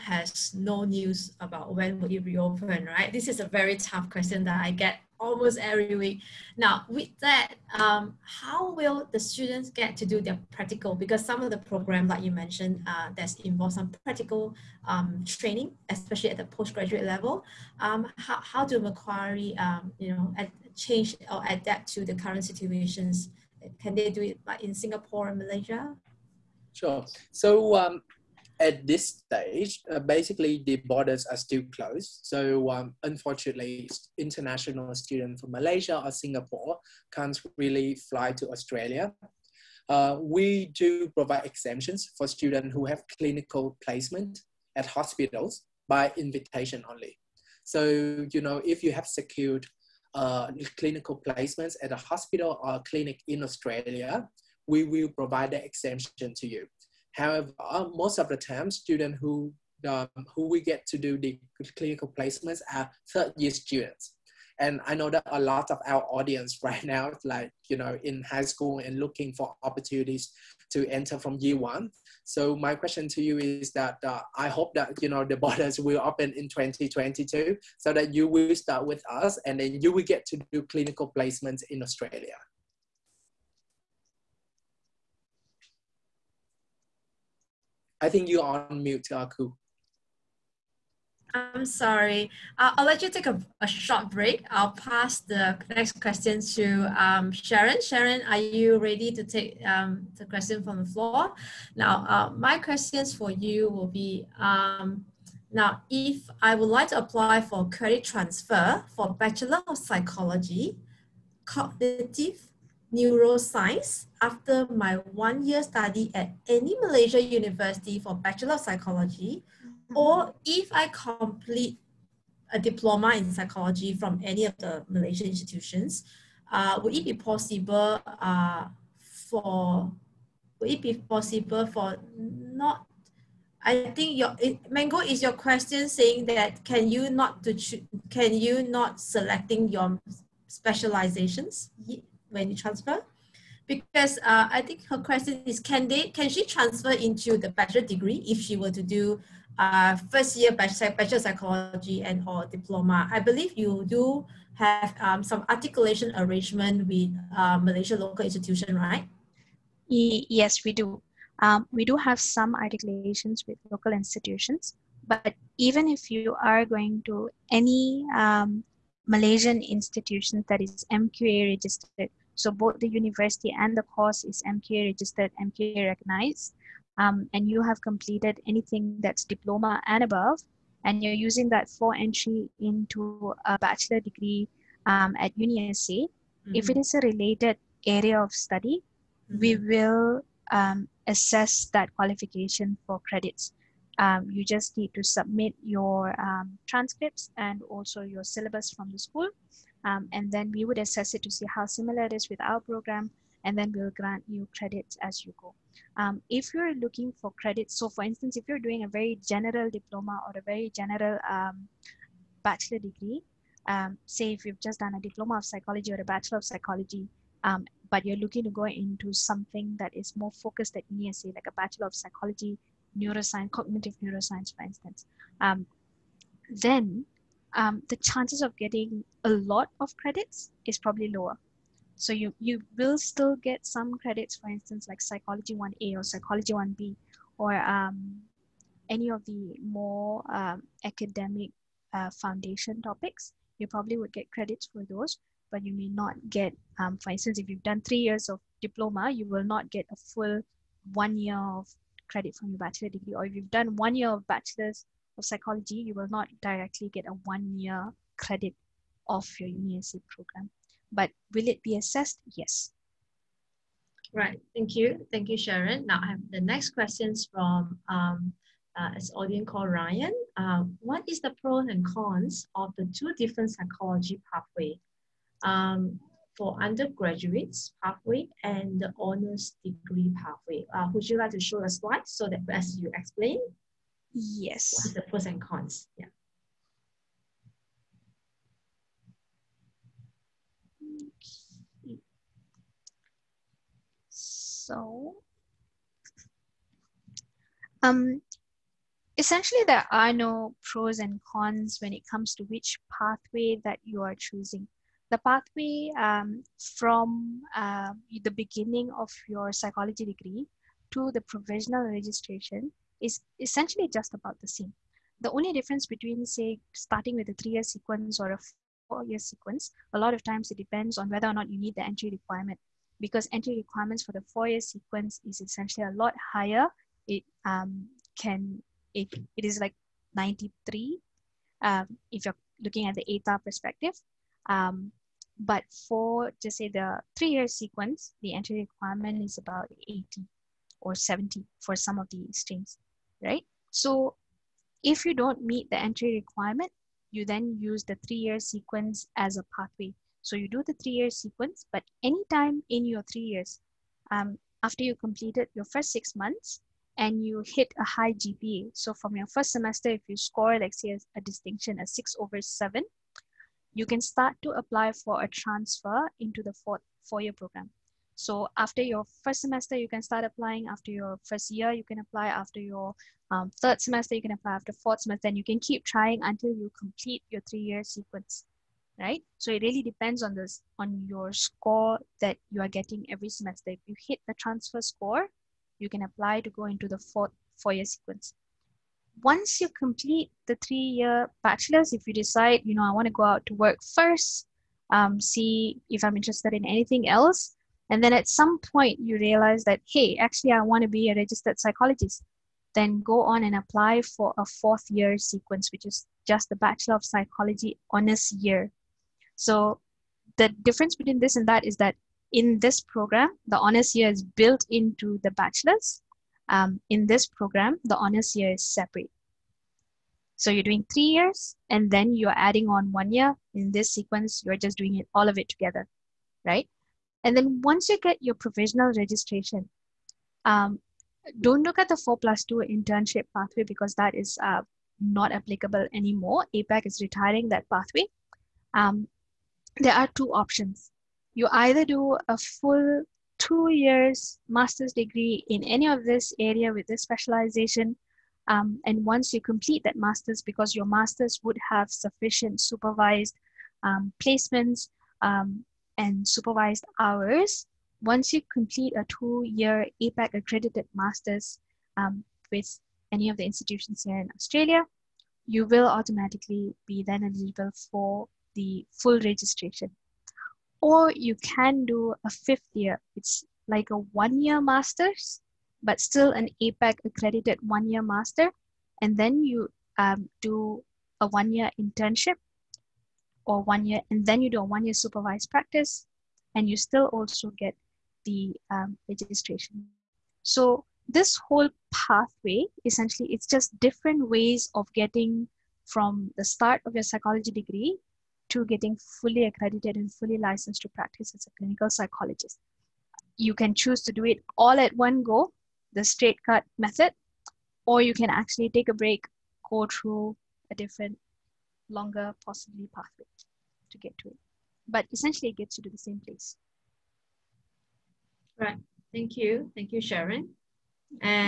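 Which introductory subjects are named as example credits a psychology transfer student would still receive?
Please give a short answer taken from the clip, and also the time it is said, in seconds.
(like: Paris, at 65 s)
Psychology 1A or 1B, at 235 s.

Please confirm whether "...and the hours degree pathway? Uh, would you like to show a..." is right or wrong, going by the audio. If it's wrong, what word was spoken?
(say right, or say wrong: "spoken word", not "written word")
wrong: "honors", not "hours".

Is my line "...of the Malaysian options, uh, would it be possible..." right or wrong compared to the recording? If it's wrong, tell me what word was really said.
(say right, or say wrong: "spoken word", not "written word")
wrong: "institutions", not "options".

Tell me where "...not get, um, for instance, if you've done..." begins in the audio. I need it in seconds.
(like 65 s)
245 s.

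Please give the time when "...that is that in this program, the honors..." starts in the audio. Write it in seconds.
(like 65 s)
411 s.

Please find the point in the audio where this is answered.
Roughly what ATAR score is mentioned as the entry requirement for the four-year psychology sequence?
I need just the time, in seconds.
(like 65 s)
330 s.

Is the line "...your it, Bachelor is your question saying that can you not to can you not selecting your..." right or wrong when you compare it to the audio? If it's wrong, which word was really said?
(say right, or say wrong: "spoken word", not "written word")
wrong: "Mango", not "Bachelor".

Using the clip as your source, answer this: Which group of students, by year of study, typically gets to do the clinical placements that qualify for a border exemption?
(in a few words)
Third year students.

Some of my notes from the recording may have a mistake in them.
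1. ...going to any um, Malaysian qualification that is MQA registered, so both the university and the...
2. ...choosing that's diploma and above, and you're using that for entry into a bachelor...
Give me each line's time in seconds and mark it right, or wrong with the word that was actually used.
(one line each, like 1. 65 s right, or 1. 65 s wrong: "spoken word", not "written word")
1. 166 s wrong: "institution", not "qualification"
2. 178 s wrong: "anything", not "choosing".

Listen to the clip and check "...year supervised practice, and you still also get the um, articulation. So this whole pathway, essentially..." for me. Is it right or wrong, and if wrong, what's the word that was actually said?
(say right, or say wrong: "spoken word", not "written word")
wrong: "registration", not "articulation".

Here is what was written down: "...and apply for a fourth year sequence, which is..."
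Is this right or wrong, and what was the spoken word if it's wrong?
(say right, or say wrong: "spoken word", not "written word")
right.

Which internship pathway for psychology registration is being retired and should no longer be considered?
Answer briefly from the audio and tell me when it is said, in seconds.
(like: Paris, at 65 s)
4 plus 2, at 431 s.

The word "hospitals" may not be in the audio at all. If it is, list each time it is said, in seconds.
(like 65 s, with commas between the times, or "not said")
44 s, 51 s.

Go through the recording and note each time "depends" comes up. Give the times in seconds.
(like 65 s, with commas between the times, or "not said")
320 s, 379 s.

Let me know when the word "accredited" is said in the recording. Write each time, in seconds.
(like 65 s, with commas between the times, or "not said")
460 s, 477 s, 499 s.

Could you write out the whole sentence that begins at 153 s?
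I believe you do have um, some articulation arrangement with uh, Malaysia local institution, right?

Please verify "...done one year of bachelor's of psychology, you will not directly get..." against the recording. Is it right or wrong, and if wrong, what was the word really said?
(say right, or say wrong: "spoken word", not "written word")
right.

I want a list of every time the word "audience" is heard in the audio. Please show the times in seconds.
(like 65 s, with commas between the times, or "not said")
66 s, 269 s.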